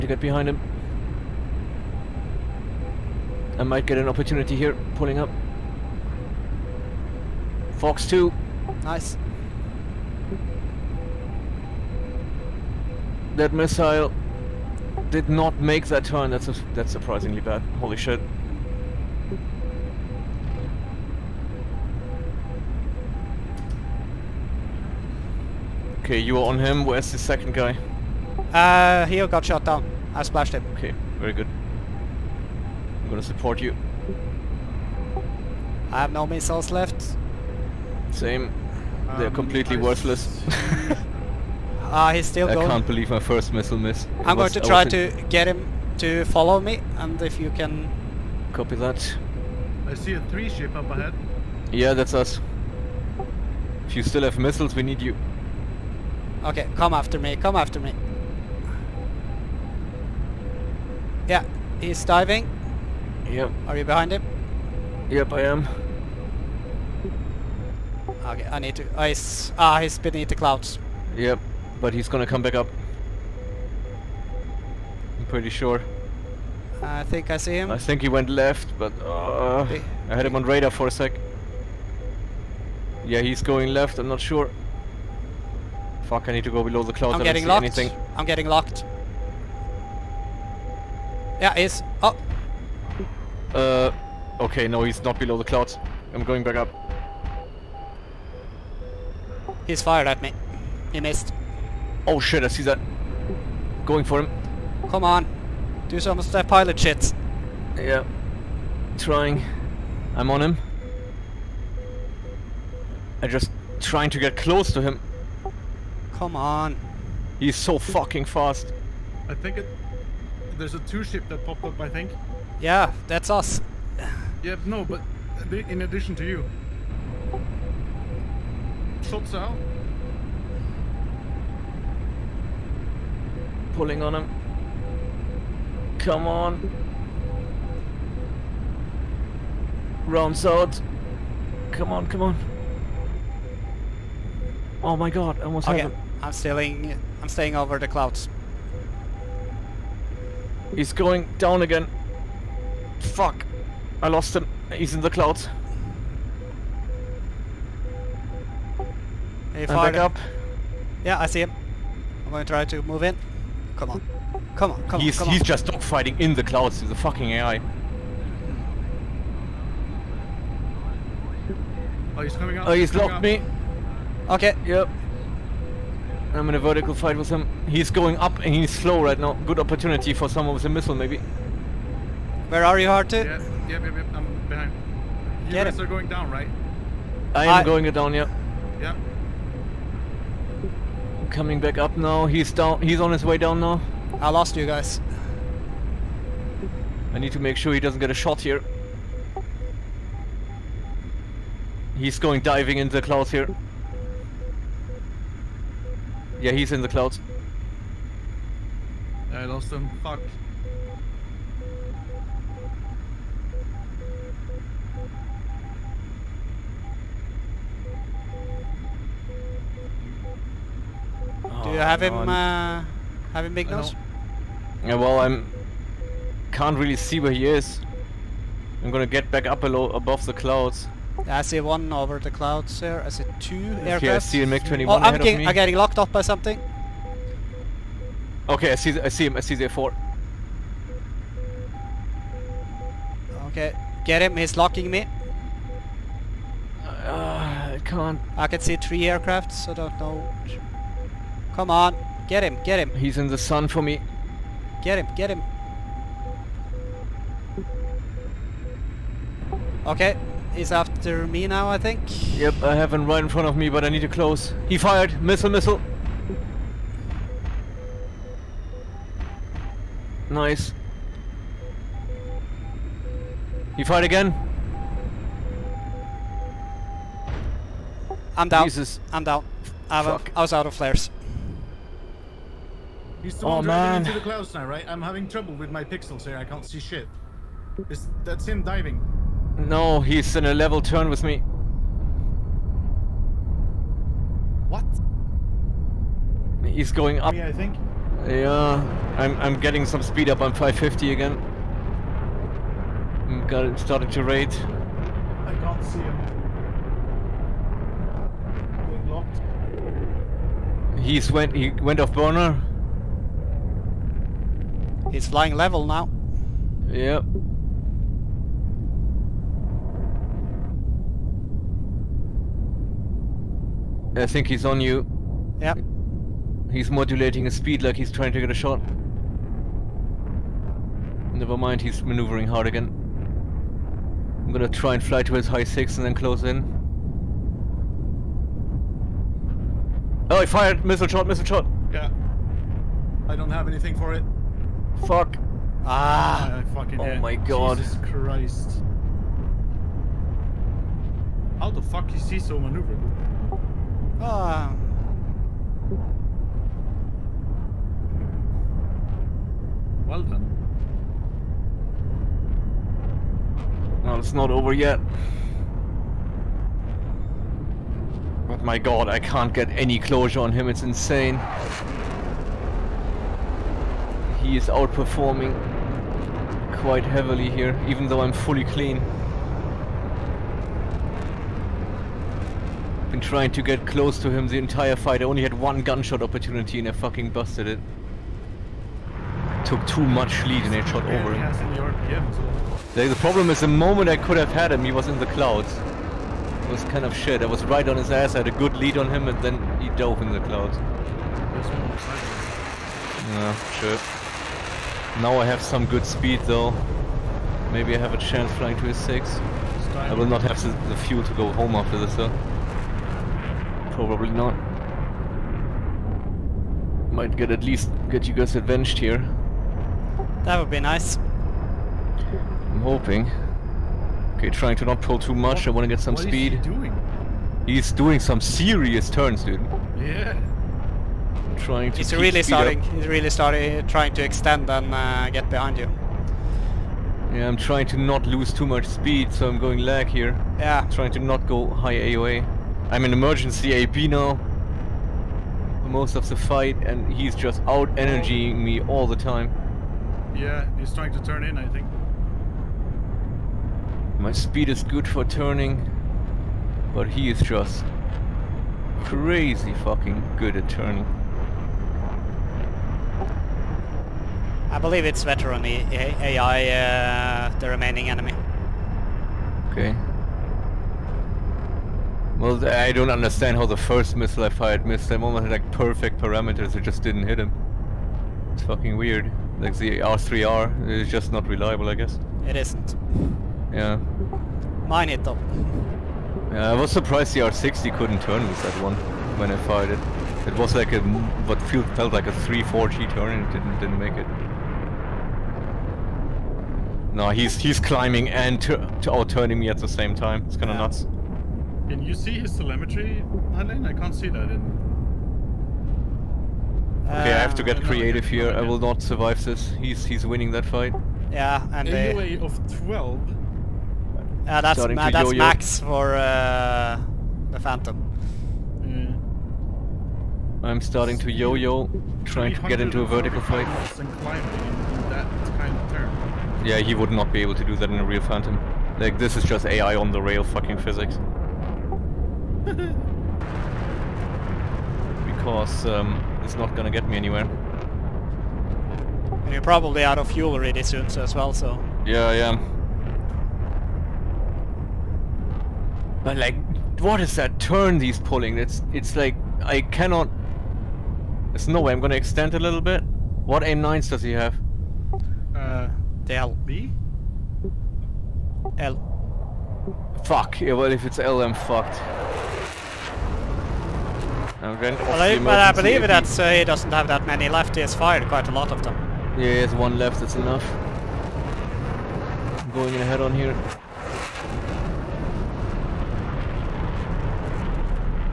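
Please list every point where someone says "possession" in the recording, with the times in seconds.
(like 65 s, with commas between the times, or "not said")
not said.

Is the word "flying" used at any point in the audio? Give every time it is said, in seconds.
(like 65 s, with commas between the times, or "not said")
315 s, 408 s.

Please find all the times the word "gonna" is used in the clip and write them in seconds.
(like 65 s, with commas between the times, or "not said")
33 s, 72 s, 228 s, 334 s, 536 s, 552 s.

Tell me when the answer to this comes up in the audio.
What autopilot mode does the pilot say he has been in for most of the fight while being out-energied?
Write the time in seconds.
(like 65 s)
443 s.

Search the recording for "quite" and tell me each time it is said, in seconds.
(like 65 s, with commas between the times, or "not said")
376 s, 568 s.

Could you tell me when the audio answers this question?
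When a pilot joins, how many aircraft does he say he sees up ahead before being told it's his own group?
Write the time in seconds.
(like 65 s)
50 s.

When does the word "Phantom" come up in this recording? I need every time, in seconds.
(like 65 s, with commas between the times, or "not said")
517 s, 528 s.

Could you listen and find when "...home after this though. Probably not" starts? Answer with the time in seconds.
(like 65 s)
411 s.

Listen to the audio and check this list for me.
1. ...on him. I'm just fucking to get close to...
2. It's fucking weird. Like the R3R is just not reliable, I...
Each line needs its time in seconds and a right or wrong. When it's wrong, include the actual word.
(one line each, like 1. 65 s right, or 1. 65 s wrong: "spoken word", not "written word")
1. 110 s wrong: "trying", not "fucking"
2. 478 s right.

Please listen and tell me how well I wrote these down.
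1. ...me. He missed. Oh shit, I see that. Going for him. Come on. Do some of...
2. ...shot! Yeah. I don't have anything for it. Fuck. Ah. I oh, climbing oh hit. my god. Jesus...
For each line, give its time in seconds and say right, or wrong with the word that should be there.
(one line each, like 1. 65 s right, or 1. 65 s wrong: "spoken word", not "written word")
1. 100 s right
2. 341 s wrong: "fucking", not "climbing".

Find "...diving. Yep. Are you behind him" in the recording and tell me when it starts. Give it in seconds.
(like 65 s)
62 s.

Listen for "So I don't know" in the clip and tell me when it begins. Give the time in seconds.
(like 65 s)
249 s.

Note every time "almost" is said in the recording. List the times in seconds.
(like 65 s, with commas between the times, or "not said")
145 s, 475 s.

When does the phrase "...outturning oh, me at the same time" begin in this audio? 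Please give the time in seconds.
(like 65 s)
498 s.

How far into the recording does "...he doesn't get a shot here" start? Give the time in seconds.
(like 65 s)
197 s.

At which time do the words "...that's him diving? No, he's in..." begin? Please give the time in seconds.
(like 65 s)
288 s.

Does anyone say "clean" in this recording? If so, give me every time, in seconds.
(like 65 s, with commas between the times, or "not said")
378 s.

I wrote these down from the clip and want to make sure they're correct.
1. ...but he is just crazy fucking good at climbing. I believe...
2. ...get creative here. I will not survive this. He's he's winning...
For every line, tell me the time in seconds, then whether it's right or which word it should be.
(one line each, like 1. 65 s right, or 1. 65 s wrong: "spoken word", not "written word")
1. 456 s wrong: "turning", not "climbing"
2. 507 s right.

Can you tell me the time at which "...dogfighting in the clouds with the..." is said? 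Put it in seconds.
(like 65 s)
165 s.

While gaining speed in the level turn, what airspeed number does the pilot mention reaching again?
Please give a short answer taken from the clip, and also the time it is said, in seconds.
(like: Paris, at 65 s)
550, at 300 s.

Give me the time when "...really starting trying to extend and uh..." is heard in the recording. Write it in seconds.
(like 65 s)
433 s.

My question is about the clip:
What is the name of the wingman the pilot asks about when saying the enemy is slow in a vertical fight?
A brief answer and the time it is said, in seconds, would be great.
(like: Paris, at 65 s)
Harte, at 182 s.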